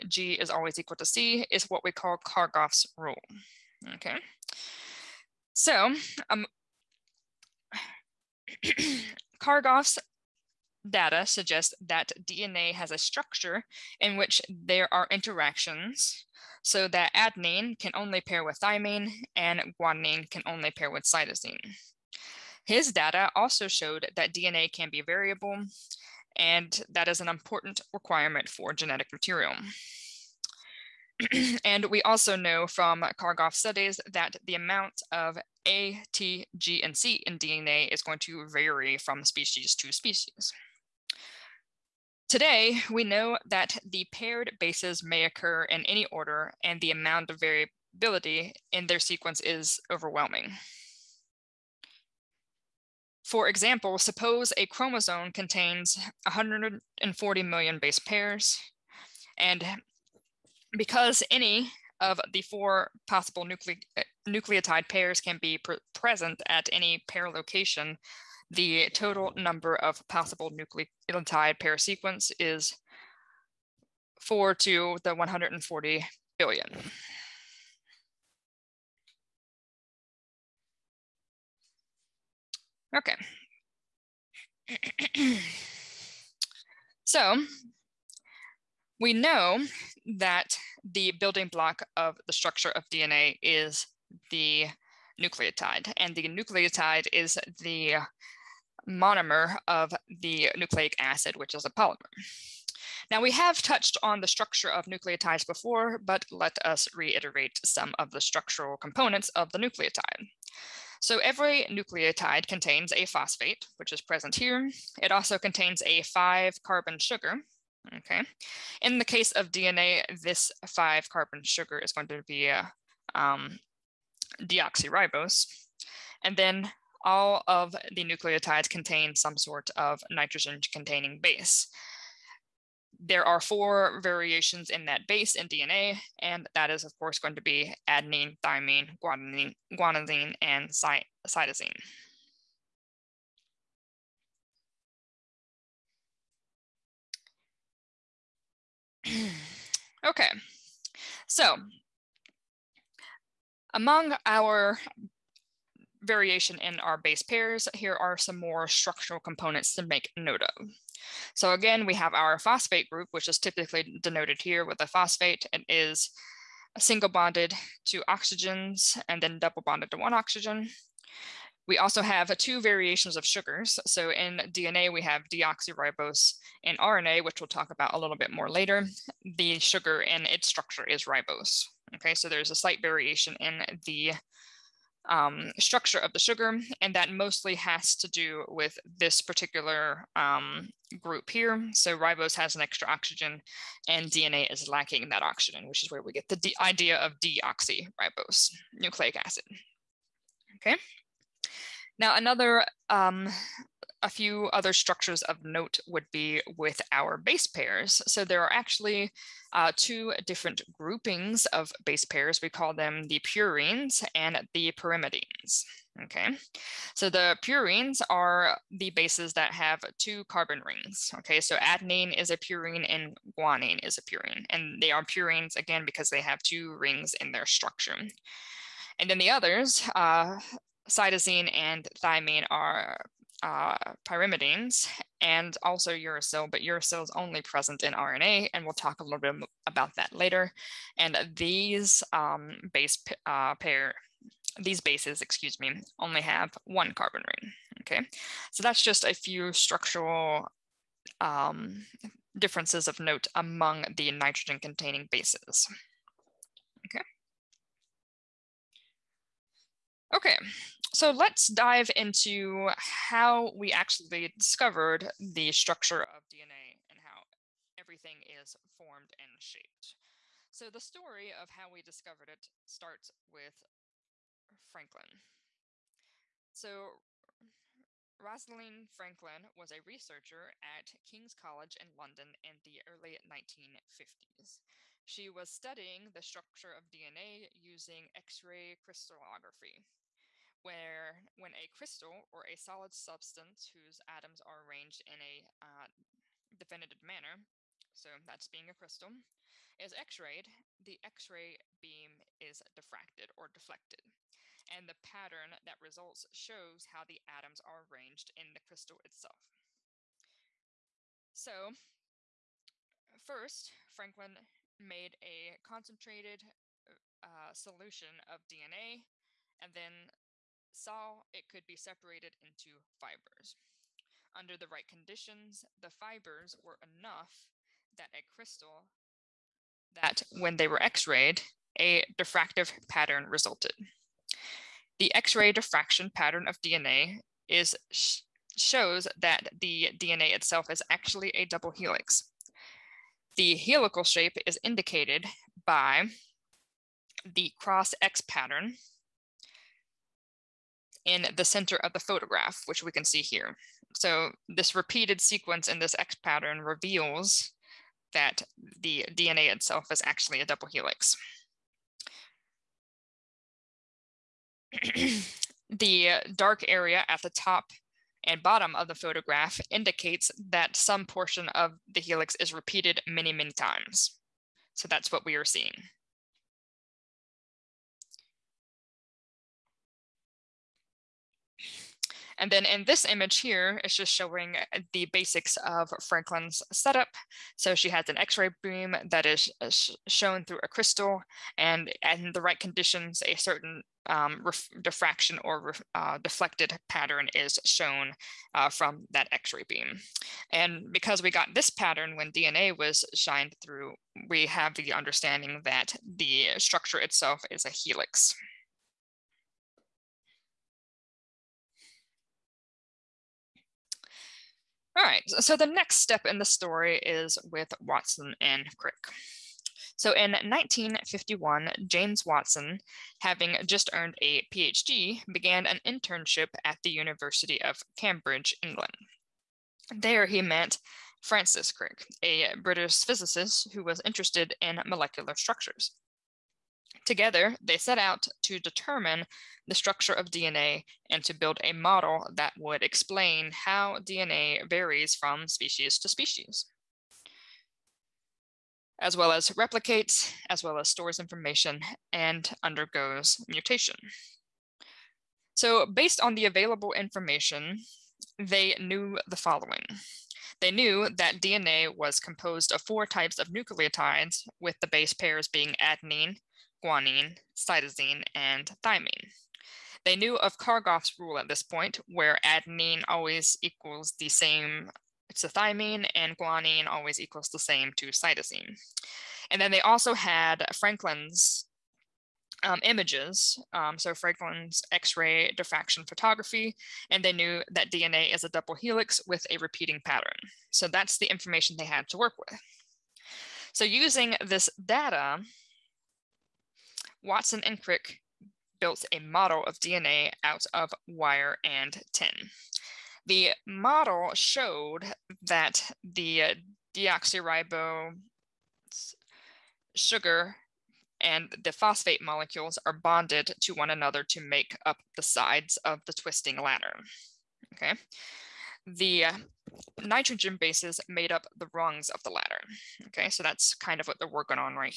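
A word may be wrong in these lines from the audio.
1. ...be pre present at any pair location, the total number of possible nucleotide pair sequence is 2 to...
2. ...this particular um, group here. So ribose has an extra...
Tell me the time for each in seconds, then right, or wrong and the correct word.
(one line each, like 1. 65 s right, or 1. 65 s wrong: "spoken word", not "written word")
1. 65 s wrong: "4", not "2"
2. 188 s right.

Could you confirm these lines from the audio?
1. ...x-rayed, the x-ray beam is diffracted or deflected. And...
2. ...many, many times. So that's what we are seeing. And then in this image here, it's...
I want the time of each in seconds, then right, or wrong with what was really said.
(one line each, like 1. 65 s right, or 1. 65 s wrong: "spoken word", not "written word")
1. 299 s right
2. 373 s right.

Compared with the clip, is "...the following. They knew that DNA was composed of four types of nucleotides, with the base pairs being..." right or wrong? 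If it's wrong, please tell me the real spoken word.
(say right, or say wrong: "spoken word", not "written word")
right.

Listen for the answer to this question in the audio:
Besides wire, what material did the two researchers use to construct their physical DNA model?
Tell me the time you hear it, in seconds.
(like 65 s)
502 s.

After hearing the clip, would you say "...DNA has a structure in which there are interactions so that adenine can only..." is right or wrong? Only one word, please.
right.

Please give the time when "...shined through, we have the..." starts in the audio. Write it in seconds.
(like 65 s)
403 s.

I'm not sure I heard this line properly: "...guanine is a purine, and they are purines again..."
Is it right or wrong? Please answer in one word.
right.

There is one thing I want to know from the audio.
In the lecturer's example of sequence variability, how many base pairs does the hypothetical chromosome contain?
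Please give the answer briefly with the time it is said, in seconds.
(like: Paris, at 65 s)
140 million, at 56 s.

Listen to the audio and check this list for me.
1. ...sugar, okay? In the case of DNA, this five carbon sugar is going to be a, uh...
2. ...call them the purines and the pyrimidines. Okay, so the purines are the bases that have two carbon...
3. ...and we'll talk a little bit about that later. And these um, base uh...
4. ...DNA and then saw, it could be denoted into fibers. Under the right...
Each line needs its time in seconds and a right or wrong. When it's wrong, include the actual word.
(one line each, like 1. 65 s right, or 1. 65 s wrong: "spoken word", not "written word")
1. 116 s right
2. 212 s right
3. 238 s right
4. 318 s wrong: "separated", not "denoted".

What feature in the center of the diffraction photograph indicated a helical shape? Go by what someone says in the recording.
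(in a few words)
cross X pattern.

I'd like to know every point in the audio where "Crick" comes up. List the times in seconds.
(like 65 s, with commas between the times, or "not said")
418 s, 431 s, 497 s.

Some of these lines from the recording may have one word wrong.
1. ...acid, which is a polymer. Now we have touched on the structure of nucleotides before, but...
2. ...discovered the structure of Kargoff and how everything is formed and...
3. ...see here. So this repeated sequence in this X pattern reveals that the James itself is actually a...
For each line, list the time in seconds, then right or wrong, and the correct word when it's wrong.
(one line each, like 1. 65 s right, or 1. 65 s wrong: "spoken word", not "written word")
1. 100 s right
2. 264 s wrong: "DNA", not "Kargoff"
3. 353 s wrong: "DNA", not "James".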